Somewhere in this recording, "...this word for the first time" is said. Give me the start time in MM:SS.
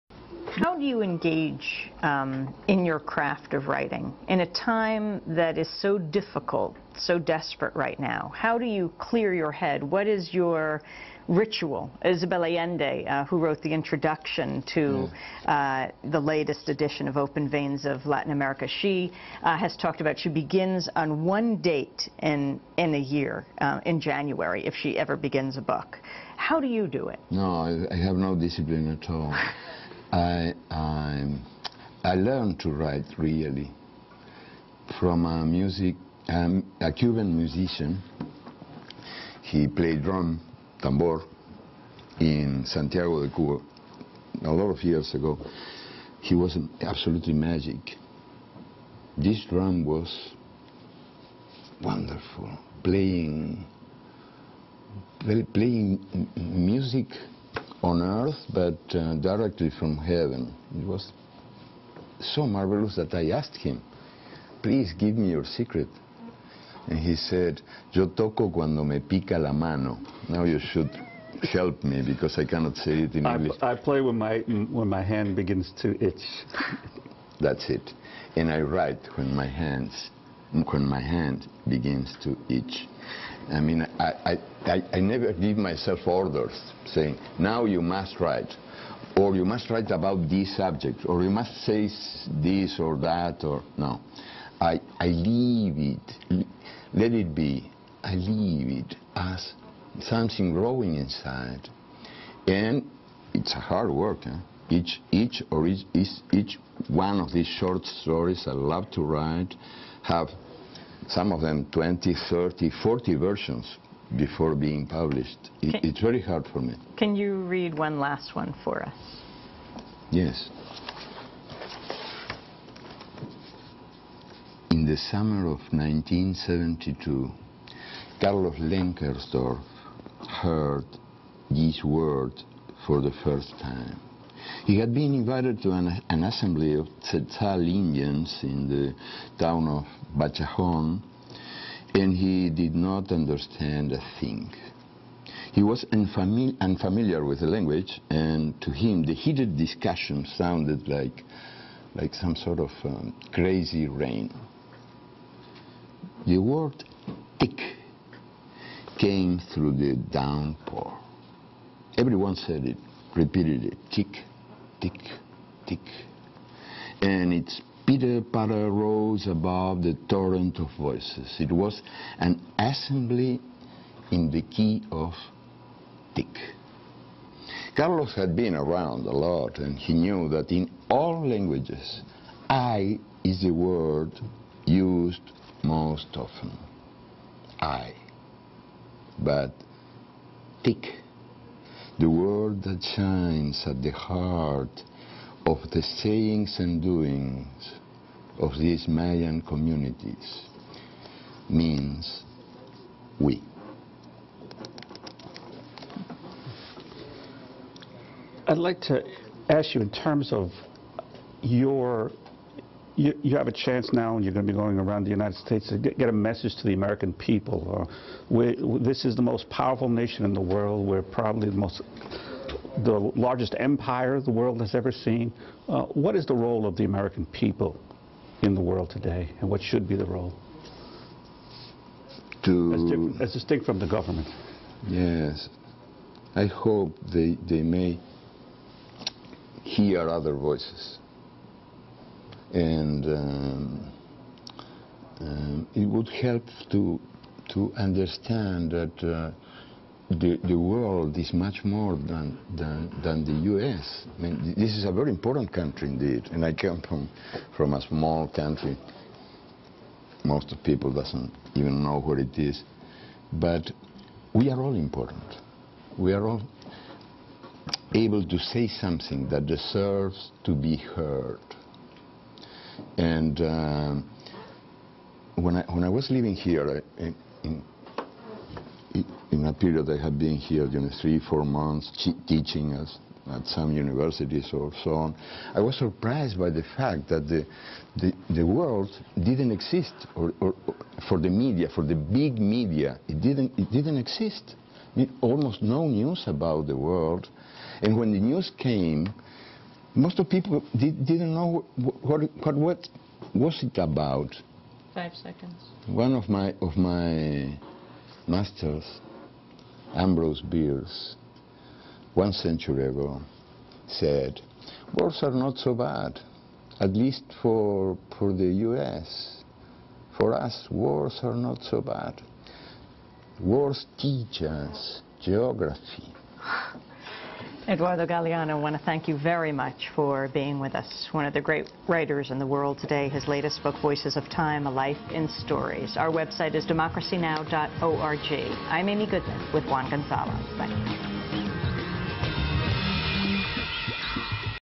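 02:11.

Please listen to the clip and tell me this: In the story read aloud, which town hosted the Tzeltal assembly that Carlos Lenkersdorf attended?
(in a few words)
Bachajon.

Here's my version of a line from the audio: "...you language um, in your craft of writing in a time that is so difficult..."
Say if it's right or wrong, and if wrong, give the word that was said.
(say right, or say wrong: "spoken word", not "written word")
wrong: "engage", not "language".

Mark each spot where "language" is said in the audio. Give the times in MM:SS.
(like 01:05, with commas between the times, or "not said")
02:27, 03:01.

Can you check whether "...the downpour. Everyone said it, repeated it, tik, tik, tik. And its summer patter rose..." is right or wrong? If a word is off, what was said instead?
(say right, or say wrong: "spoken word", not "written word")
wrong: "pitter", not "summer".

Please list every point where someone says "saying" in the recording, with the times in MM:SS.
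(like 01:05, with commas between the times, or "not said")
01:26, 03:15.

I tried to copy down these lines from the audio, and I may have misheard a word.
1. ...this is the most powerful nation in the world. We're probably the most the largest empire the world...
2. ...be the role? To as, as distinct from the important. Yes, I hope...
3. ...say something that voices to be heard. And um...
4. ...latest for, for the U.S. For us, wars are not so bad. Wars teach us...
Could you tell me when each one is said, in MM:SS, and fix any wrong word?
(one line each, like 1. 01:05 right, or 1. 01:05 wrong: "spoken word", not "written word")
1. 03:38 right
2. 03:49 wrong: "government", not "important"
3. 04:28 wrong: "deserves", not "voices"
4. 05:16 wrong: "least", not "latest".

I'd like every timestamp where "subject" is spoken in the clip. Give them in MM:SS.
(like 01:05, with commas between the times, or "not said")
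01:30.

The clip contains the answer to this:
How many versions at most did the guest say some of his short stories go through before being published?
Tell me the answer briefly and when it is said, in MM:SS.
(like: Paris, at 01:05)
40, at 01:52.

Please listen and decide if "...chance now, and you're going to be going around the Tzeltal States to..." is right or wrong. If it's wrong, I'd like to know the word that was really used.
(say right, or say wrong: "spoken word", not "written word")
wrong: "United", not "Tzeltal".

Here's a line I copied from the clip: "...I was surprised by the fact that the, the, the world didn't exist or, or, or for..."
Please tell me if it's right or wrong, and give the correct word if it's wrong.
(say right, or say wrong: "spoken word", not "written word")
right.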